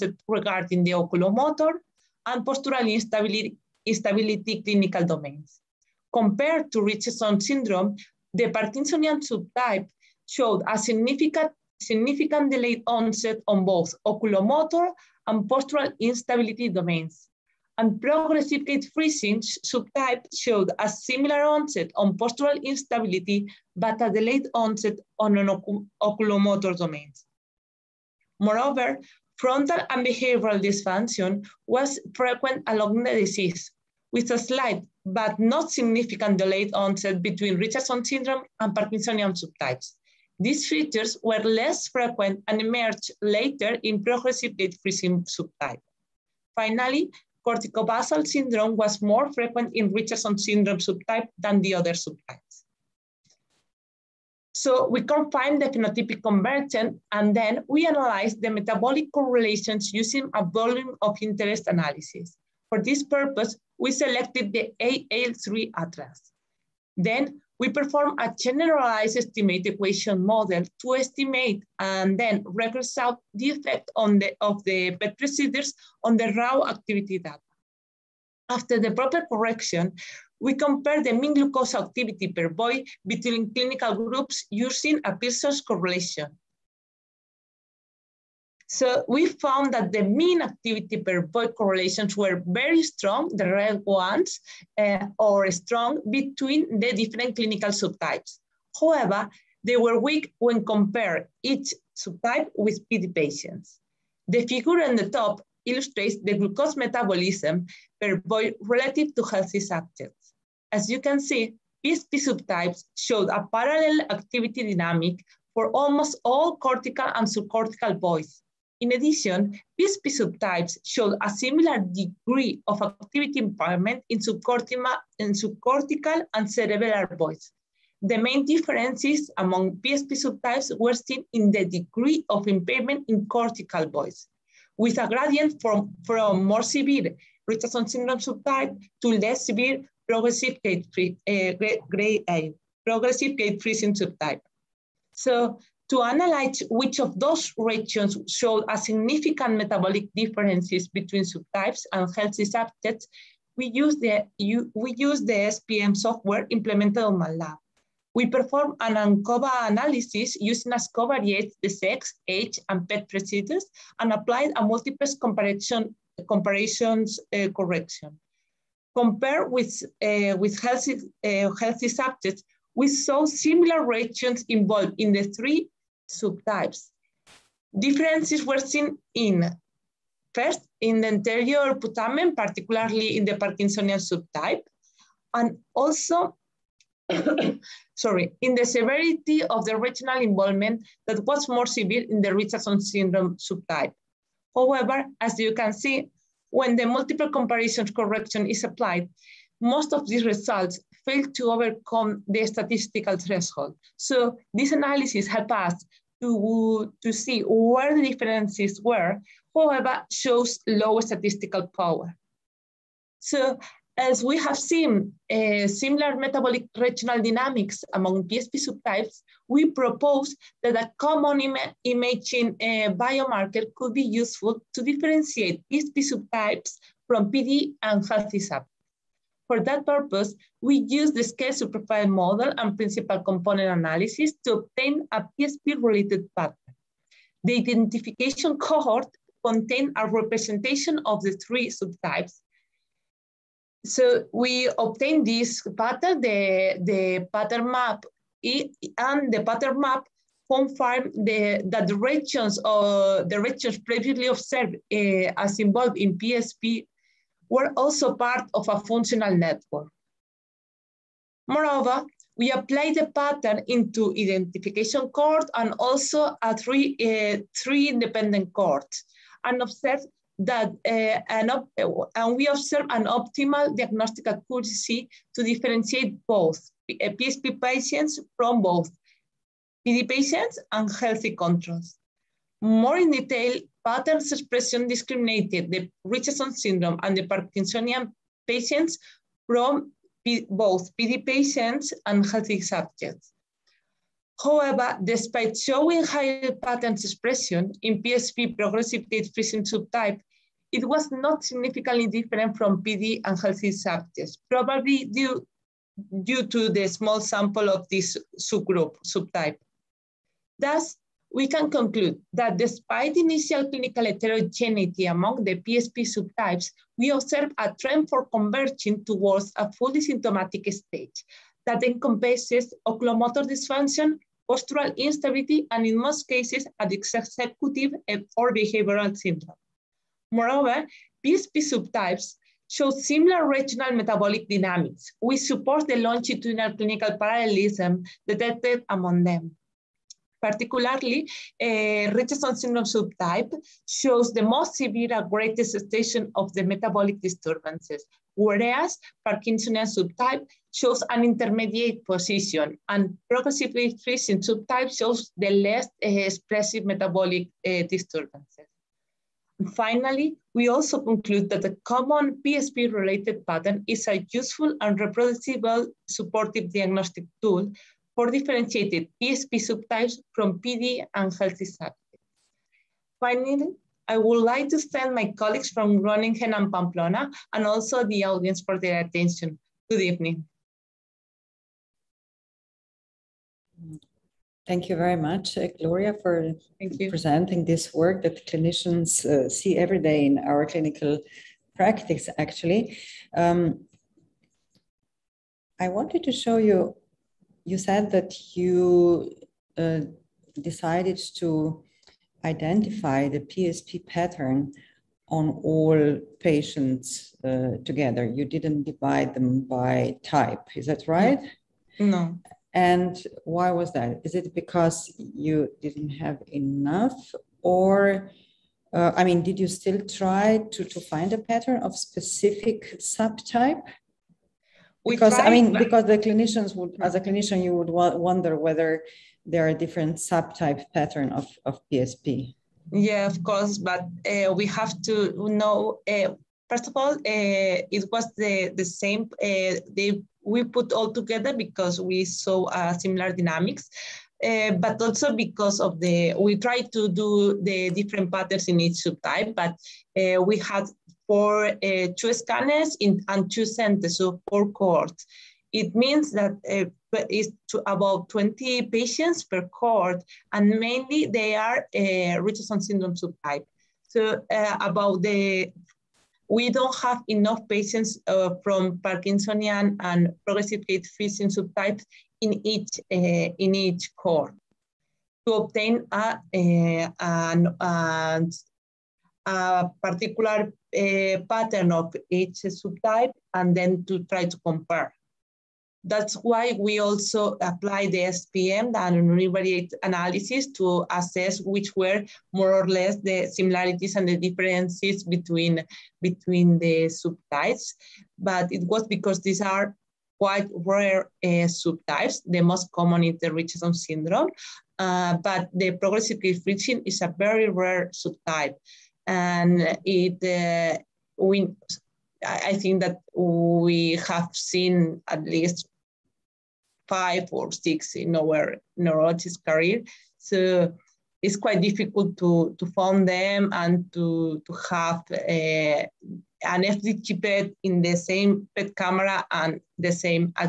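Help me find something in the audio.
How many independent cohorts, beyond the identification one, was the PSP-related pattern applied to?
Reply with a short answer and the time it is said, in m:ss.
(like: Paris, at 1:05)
3, at 4:27.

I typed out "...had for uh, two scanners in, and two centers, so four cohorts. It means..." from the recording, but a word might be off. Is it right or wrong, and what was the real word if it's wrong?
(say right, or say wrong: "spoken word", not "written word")
right.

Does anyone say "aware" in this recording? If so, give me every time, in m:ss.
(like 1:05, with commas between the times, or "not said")
not said.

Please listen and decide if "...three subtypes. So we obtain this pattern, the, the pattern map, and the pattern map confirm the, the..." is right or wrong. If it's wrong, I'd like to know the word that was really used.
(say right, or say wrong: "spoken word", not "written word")
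right.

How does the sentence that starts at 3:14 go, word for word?
However, as you can see, when the multiple comparisons correction is applied, most of these results failed to overcome the statistical threshold.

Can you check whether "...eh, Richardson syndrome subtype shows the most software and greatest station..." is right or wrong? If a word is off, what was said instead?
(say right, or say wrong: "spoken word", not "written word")
wrong: "severe", not "software".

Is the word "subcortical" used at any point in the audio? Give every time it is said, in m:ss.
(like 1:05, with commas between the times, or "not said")
1:57, 2:05.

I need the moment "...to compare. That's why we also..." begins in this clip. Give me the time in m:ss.
8:04.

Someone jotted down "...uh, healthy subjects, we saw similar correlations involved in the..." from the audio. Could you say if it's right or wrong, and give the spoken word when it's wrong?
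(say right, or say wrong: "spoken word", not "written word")
wrong: "regions", not "correlations".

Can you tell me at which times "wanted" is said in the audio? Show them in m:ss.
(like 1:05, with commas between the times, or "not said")
6:35.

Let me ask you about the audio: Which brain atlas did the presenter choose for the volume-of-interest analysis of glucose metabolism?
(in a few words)
AAL3.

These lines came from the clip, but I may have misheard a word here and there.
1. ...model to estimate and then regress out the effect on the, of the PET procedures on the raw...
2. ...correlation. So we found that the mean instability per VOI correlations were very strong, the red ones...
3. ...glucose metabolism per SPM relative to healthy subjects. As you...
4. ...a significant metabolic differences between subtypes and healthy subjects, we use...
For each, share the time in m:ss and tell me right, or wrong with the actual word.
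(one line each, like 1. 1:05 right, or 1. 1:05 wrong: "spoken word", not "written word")
1. 1:10 right
2. 1:25 wrong: "activity", not "instability"
3. 1:46 wrong: "VOI", not "SPM"
4. 2:28 right.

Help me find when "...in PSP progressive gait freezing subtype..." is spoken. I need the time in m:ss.
4:57.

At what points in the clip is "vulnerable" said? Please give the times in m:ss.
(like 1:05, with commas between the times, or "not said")
not said.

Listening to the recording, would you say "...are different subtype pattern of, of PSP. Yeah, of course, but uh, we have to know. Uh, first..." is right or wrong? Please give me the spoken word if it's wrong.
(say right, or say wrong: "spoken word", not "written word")
right.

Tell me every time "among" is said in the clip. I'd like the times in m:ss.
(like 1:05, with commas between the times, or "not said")
2:09, 3:37, 5:15, 5:38.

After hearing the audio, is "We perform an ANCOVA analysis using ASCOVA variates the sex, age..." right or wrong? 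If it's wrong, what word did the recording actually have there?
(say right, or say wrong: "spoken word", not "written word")
right.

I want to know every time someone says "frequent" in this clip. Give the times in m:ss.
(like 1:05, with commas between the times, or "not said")
0:32, 0:41, 0:49.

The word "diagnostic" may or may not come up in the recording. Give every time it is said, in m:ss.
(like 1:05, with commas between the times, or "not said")
4:33, 6:06.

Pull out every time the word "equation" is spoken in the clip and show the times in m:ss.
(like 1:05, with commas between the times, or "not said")
1:09.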